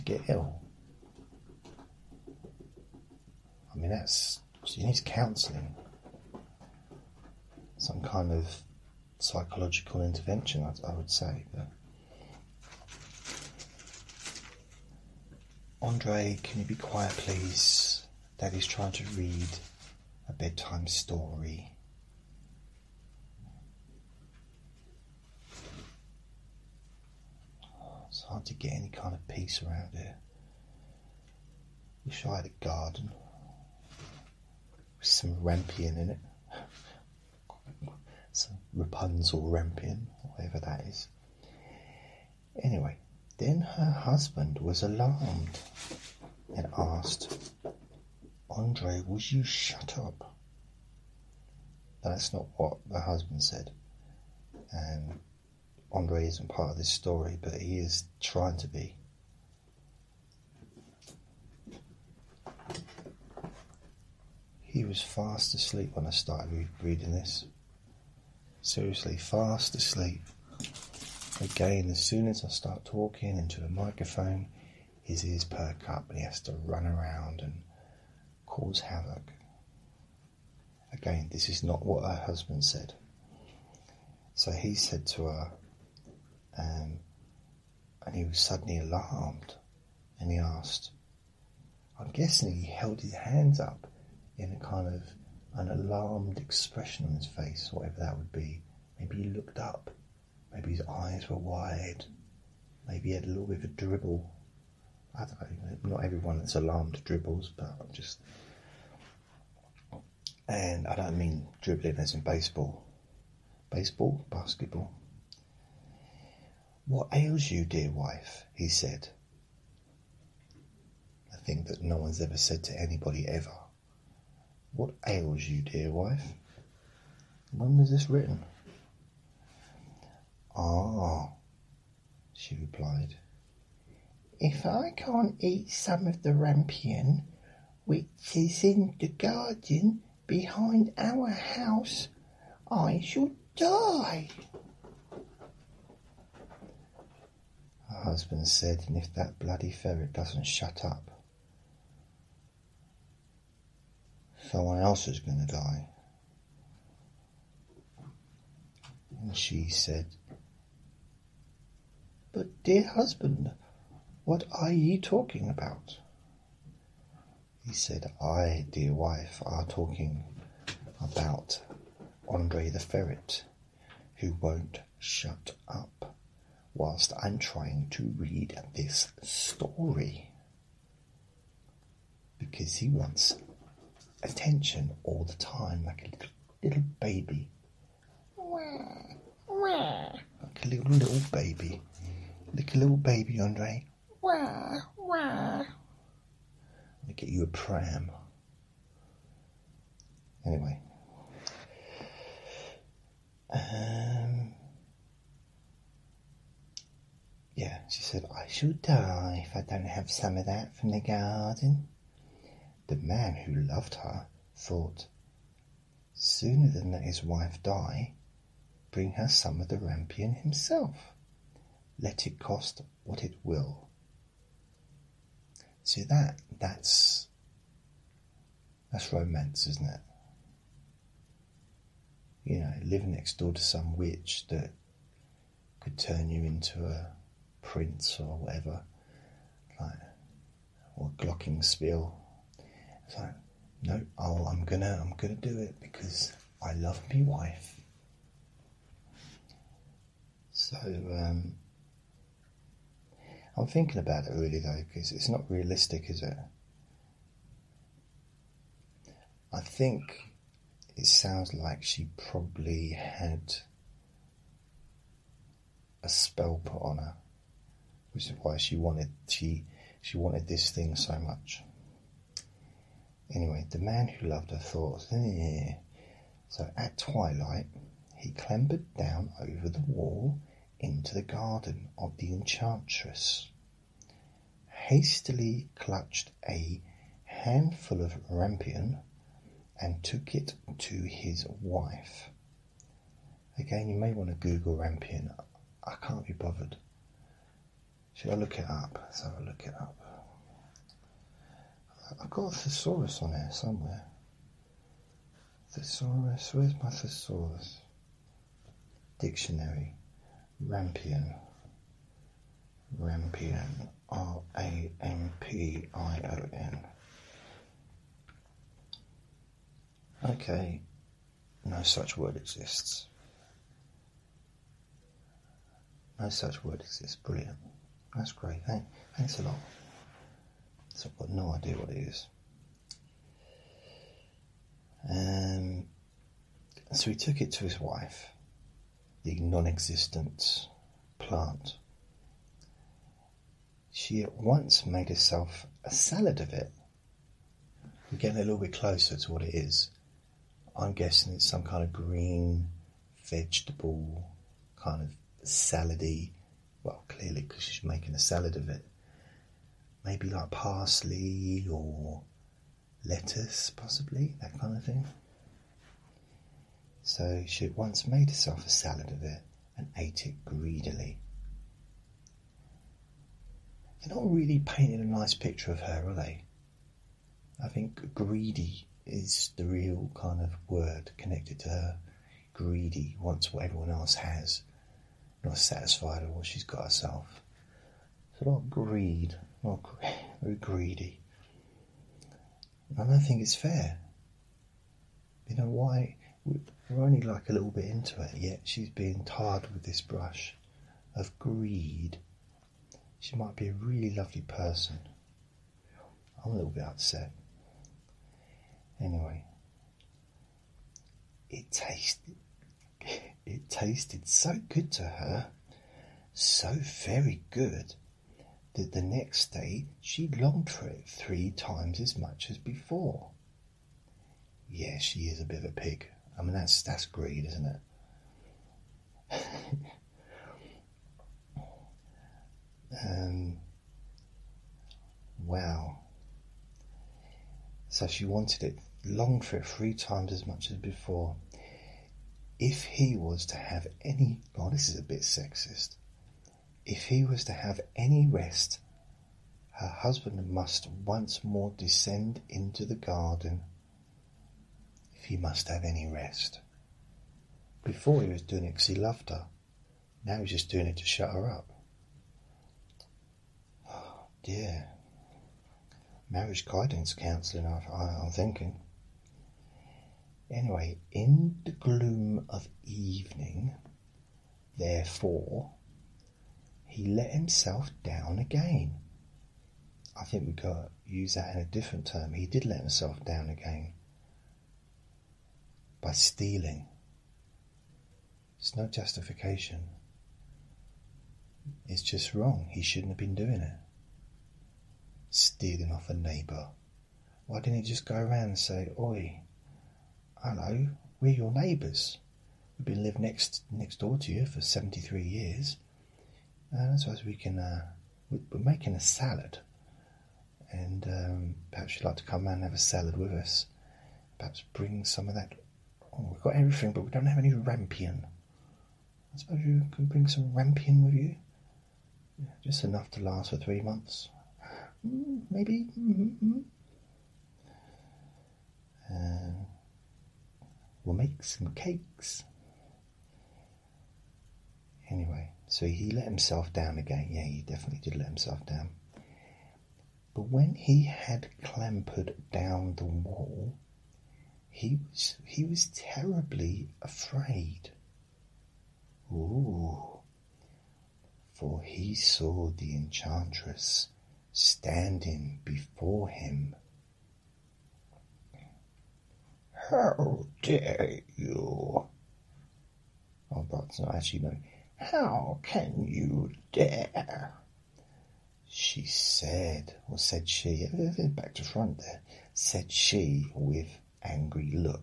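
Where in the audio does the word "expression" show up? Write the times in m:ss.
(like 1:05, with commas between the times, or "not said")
1:36.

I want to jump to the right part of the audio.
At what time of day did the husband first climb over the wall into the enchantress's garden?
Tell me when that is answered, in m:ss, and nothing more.
4:36.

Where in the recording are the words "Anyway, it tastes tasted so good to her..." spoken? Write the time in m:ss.
6:48.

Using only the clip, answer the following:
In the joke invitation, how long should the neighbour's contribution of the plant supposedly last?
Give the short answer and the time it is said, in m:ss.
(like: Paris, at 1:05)
Three months, at 8:43.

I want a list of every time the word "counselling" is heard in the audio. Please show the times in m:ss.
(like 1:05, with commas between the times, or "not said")
0:04, 7:47.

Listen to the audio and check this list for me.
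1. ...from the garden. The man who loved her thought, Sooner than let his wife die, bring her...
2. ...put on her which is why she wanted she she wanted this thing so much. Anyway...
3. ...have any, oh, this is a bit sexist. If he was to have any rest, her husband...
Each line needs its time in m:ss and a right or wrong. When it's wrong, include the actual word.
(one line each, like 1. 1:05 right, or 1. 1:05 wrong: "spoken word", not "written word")
1. 3:30 right
2. 4:26 right
3. 7:23 right.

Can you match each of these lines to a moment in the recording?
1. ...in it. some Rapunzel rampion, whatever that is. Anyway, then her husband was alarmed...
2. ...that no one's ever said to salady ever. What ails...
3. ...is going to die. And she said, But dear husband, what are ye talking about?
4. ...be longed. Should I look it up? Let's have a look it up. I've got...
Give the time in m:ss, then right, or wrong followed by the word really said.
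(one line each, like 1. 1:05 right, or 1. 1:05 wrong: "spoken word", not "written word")
1. 0:35 right
2. 2:01 wrong: "anybody", not "salady"
3. 2:35 right
4. 4:56 wrong: "bothered", not "longed".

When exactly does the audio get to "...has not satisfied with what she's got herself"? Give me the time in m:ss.
6:24.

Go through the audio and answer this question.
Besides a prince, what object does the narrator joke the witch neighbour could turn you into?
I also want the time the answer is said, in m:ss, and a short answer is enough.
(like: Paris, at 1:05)
Glockenspiel, at 4:01.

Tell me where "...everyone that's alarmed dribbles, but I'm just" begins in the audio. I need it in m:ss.
1:46.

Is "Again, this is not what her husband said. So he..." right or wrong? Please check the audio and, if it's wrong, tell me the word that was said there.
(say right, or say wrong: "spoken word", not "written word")
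right.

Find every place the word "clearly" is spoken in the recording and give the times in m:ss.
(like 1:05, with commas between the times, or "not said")
5:57.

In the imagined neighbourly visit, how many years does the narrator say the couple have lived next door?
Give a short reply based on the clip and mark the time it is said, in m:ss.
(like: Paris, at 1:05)
73, at 8:24.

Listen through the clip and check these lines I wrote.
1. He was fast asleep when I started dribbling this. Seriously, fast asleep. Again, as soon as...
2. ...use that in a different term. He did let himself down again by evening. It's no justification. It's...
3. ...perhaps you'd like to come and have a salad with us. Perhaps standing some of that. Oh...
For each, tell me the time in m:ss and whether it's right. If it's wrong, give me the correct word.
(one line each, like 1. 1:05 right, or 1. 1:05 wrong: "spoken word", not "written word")
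1. 1:04 wrong: "reading", not "dribbling"
2. 8:01 wrong: "stealing", not "evening"
3. 8:31 wrong: "bring", not "standing".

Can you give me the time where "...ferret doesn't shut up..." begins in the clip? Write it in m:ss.
2:29.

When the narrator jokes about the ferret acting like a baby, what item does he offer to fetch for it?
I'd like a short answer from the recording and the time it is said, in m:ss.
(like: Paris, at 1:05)
A pram, at 3:17.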